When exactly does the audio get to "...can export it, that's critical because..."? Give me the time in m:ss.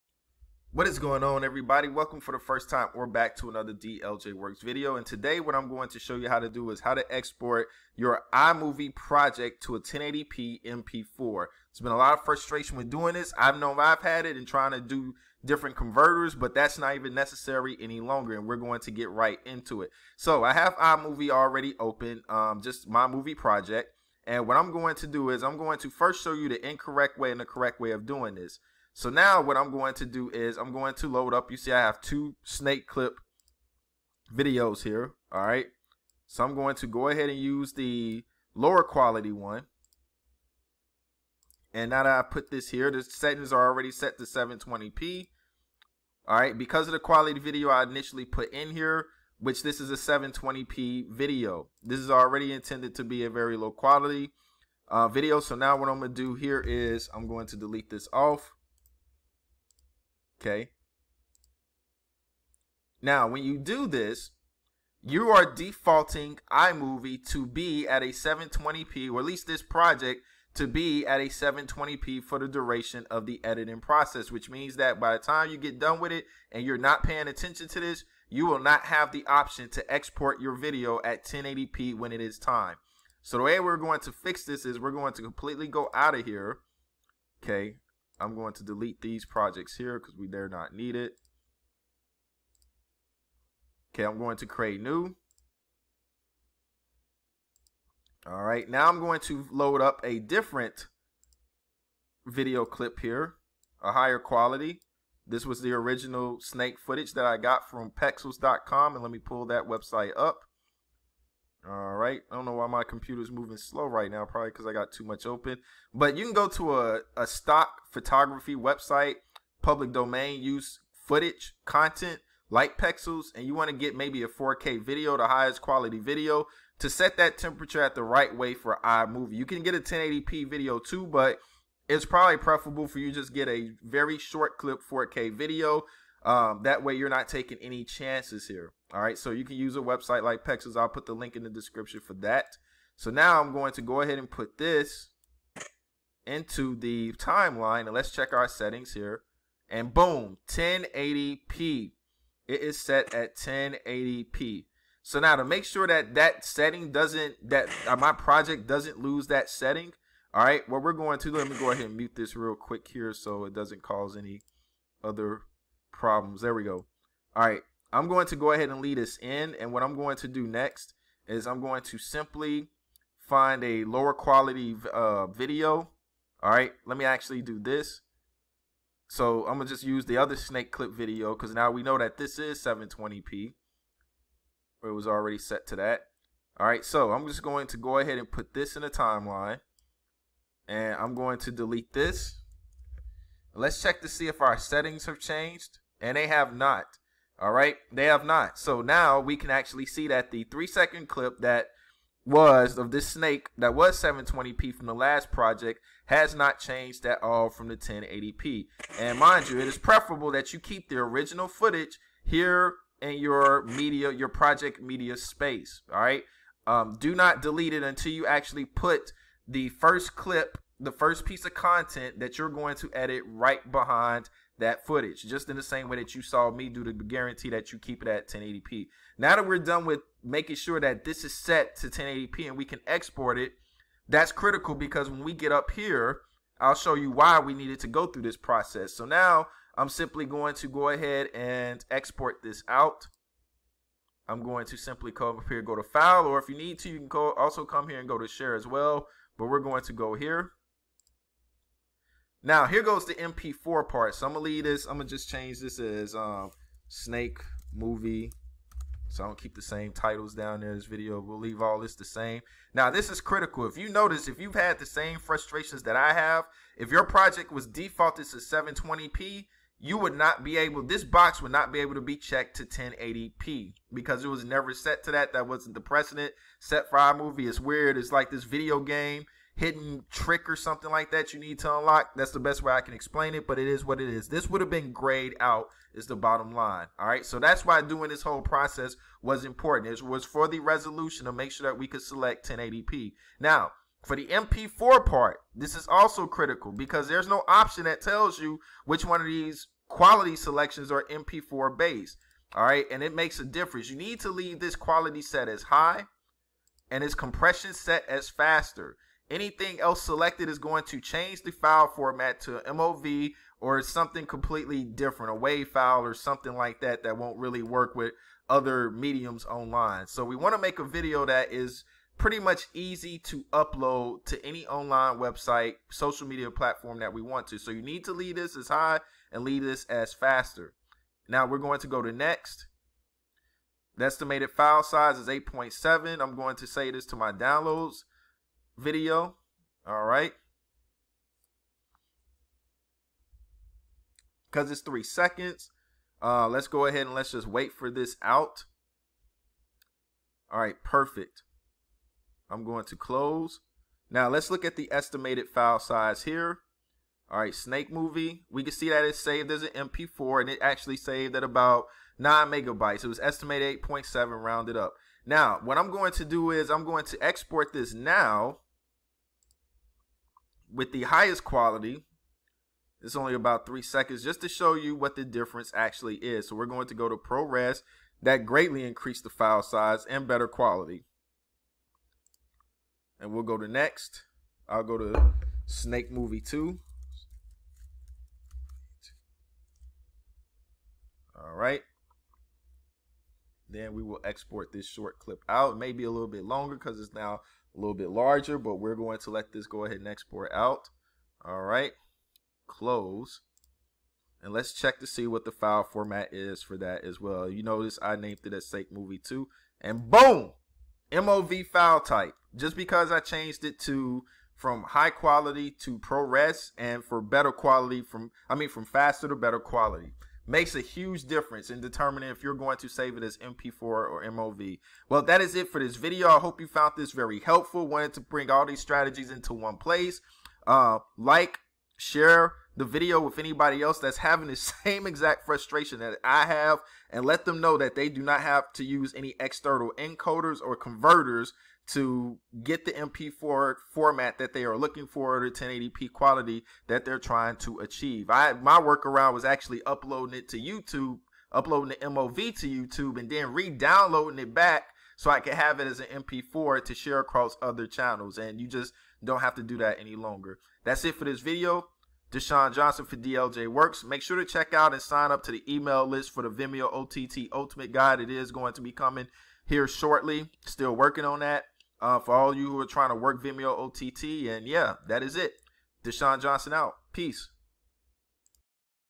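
3:52.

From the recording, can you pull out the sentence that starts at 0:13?
I've known I've had it and trying to do different converters, but that's not even necessary any longer.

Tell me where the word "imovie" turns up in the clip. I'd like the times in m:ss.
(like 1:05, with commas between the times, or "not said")
0:08, 0:20, 1:06, 2:08.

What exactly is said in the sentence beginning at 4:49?
It was for the resolution to make sure that we could select 1080p.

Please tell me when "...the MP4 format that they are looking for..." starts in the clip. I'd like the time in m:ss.
7:22.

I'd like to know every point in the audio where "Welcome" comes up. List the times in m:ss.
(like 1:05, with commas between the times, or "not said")
0:01.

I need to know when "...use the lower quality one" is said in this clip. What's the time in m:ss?
0:37.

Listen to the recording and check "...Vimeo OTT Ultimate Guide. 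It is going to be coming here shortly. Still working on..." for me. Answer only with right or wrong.
right.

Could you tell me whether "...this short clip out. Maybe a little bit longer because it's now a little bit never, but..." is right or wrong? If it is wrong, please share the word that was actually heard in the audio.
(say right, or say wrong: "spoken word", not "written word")
wrong: "larger", not "never".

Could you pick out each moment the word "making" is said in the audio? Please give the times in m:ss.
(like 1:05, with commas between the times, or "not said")
3:50.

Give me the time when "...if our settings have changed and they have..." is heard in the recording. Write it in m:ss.
3:14.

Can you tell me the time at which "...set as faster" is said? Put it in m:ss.
5:07.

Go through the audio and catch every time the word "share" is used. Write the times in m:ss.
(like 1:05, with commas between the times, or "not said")
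4:08, 7:11, 7:36.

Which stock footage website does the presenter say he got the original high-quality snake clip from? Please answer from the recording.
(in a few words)
Pexels.com.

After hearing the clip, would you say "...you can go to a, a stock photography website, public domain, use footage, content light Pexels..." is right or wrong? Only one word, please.
right.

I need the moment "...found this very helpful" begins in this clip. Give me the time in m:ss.
7:06.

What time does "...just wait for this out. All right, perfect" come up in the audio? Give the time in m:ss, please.
5:47.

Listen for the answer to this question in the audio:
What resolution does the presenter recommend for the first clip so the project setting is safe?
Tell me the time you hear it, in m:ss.
2:14.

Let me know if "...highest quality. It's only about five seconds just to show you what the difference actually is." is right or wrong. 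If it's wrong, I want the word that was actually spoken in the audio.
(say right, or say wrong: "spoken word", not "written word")
wrong: "three", not "five".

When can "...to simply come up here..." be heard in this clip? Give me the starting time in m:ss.
4:04.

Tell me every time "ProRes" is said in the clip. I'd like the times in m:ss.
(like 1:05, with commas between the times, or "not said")
6:17, 6:55.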